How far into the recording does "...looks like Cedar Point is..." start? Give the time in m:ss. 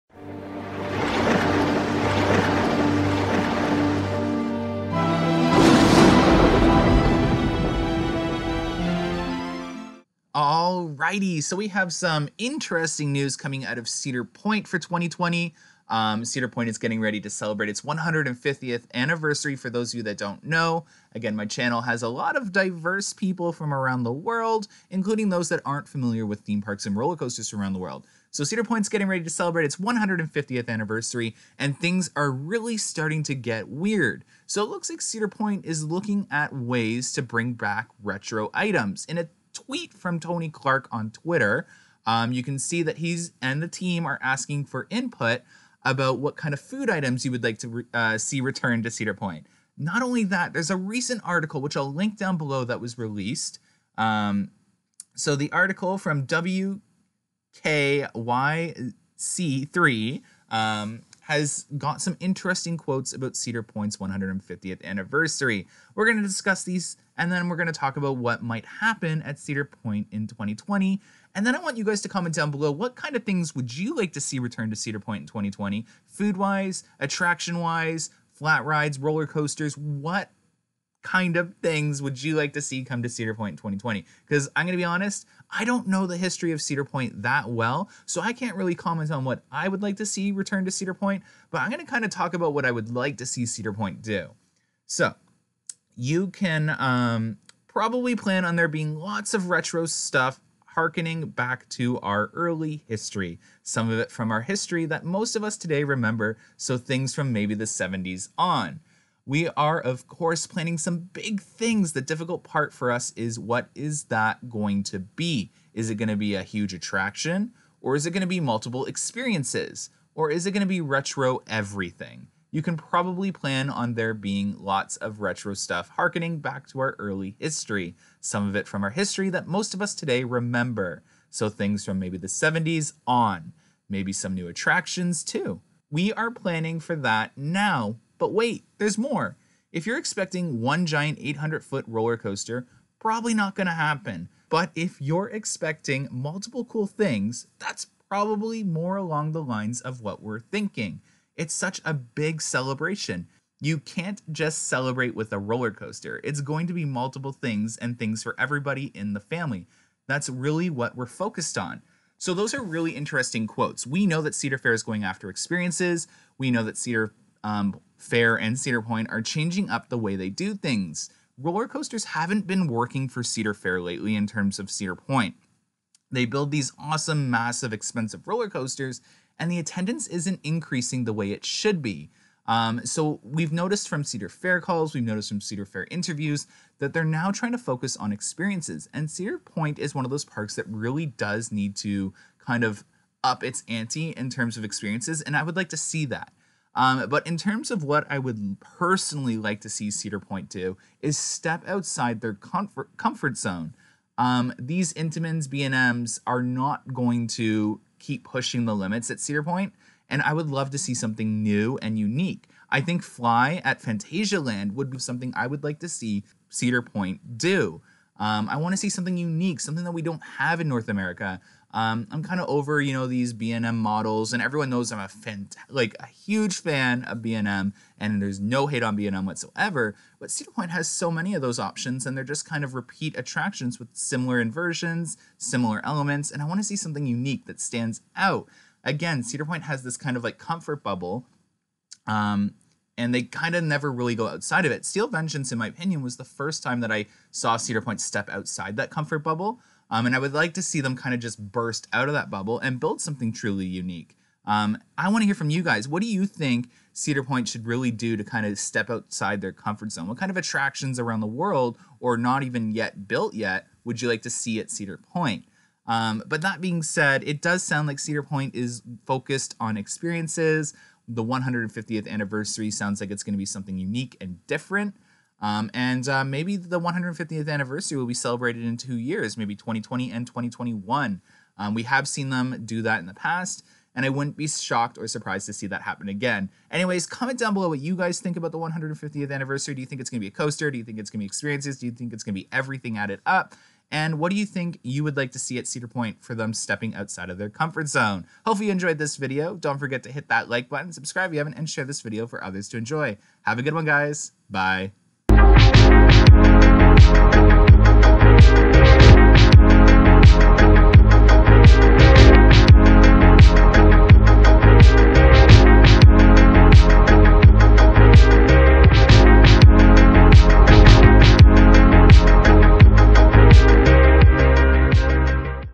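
0:34.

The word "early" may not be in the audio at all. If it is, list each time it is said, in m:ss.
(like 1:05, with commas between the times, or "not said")
1:42, 2:06.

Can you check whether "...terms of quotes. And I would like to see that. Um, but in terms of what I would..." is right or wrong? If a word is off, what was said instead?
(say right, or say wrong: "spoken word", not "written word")
wrong: "experiences", not "quotes".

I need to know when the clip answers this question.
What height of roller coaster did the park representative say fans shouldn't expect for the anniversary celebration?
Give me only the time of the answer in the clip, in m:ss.
2:21.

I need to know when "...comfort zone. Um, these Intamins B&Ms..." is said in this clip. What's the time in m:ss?
3:22.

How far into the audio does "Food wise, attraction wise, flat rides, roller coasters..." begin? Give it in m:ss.
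1:16.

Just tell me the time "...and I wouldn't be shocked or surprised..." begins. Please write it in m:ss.
4:43.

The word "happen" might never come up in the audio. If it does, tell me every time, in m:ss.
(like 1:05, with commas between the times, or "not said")
1:08, 2:23, 4:45.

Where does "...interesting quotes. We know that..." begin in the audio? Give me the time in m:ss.
2:42.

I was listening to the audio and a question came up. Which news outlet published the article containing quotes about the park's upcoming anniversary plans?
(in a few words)
WKYC3.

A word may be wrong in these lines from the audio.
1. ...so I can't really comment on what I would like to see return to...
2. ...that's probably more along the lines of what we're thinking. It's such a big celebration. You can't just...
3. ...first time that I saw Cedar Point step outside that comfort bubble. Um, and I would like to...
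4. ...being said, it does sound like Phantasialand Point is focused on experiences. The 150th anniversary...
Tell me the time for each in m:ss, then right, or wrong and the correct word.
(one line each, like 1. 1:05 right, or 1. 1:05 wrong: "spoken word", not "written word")
1. 1:28 right
2. 2:27 right
3. 4:06 right
4. 4:26 wrong: "Cedar", not "Phantasialand".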